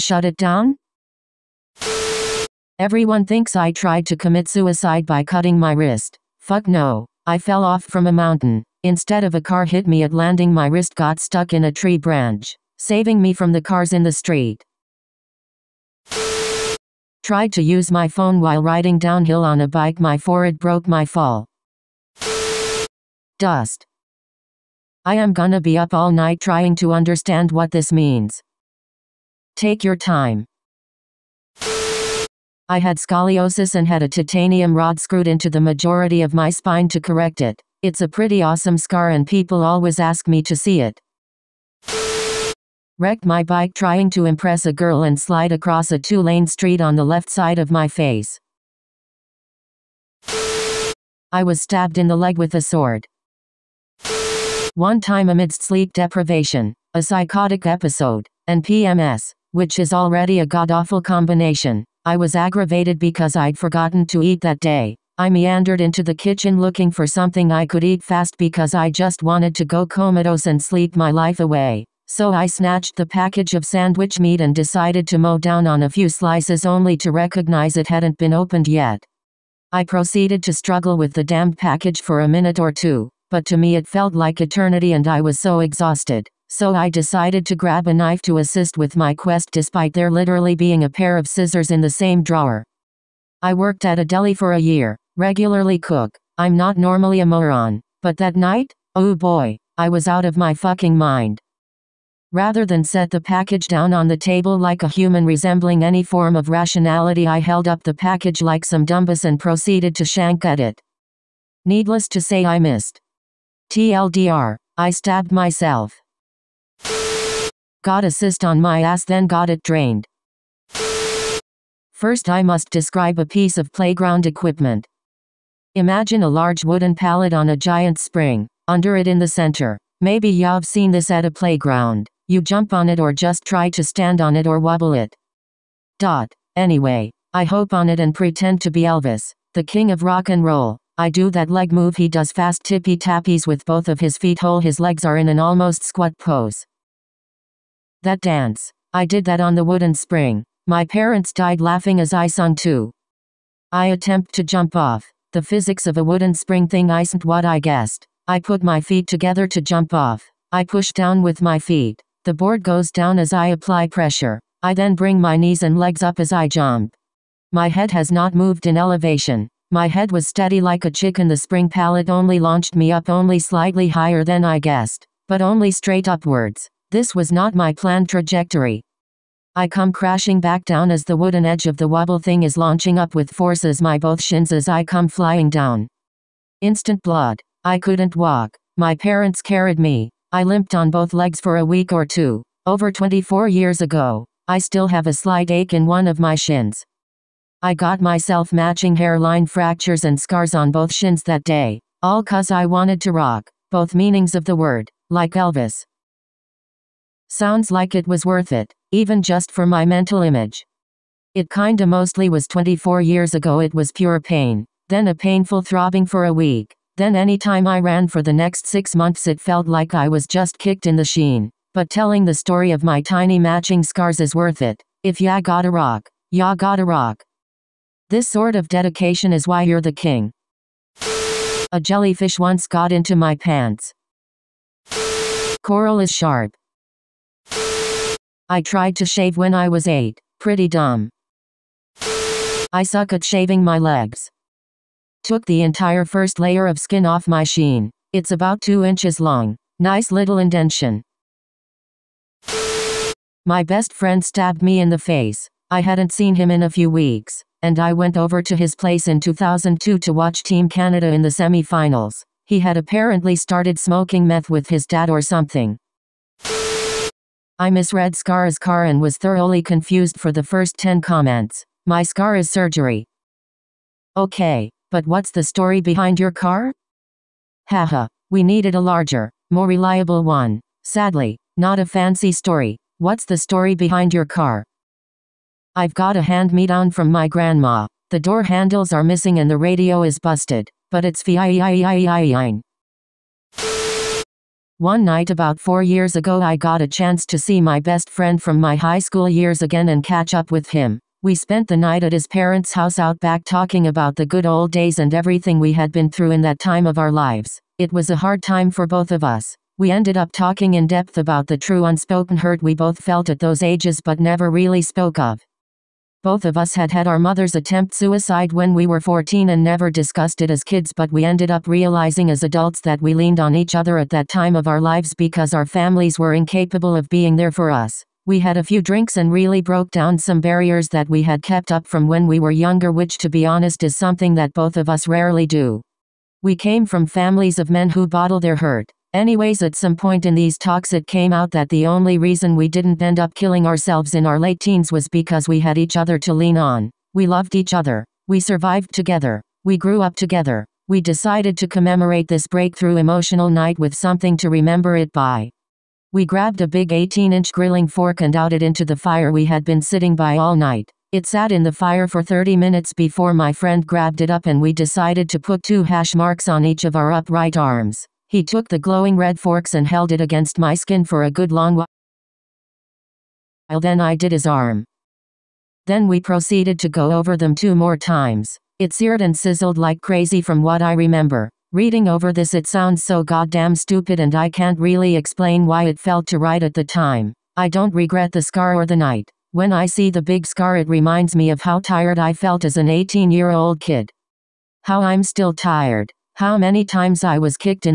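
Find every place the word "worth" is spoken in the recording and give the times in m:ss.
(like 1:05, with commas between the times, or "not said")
3:28, 3:44.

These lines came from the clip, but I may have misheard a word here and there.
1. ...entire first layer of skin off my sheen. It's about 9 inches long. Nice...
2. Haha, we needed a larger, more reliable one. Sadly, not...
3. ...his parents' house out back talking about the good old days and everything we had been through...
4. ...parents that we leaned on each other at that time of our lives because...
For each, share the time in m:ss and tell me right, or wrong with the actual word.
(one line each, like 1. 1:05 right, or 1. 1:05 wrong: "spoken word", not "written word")
1. 4:05 wrong: "2", not "9"
2. 4:37 right
3. 5:02 right
4. 5:22 wrong: "adults", not "parents".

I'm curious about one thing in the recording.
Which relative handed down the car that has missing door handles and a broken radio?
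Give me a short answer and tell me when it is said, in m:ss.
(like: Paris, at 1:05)
grandma, at 4:47.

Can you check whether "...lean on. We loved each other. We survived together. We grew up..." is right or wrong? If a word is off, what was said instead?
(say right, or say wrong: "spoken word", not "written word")
right.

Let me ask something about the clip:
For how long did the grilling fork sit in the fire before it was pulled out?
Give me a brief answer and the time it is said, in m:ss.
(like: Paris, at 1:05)
30 minutes, at 6:02.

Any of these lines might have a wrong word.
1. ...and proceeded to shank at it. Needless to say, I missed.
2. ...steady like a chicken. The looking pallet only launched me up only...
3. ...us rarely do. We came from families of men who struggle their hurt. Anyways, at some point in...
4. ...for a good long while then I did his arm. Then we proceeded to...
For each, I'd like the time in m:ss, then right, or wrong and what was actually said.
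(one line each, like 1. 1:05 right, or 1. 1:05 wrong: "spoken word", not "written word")
1. 1:49 right
2. 2:50 wrong: "spring", not "looking"
3. 5:34 wrong: "bottle", not "struggle"
4. 6:11 right.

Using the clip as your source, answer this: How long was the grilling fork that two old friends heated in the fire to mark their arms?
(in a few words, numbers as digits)
18-inch.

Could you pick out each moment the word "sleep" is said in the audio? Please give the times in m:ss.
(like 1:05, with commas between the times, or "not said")
0:55, 1:10.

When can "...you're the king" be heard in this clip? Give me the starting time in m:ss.
3:49.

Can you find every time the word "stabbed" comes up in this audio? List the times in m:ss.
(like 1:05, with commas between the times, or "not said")
0:51, 1:54, 4:14.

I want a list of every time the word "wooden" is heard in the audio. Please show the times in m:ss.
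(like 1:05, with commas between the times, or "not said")
2:06, 2:29, 2:36, 3:01.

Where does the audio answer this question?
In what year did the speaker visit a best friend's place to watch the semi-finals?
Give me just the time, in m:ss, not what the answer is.
4:19.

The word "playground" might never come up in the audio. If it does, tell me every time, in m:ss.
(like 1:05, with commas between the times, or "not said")
2:03, 2:11.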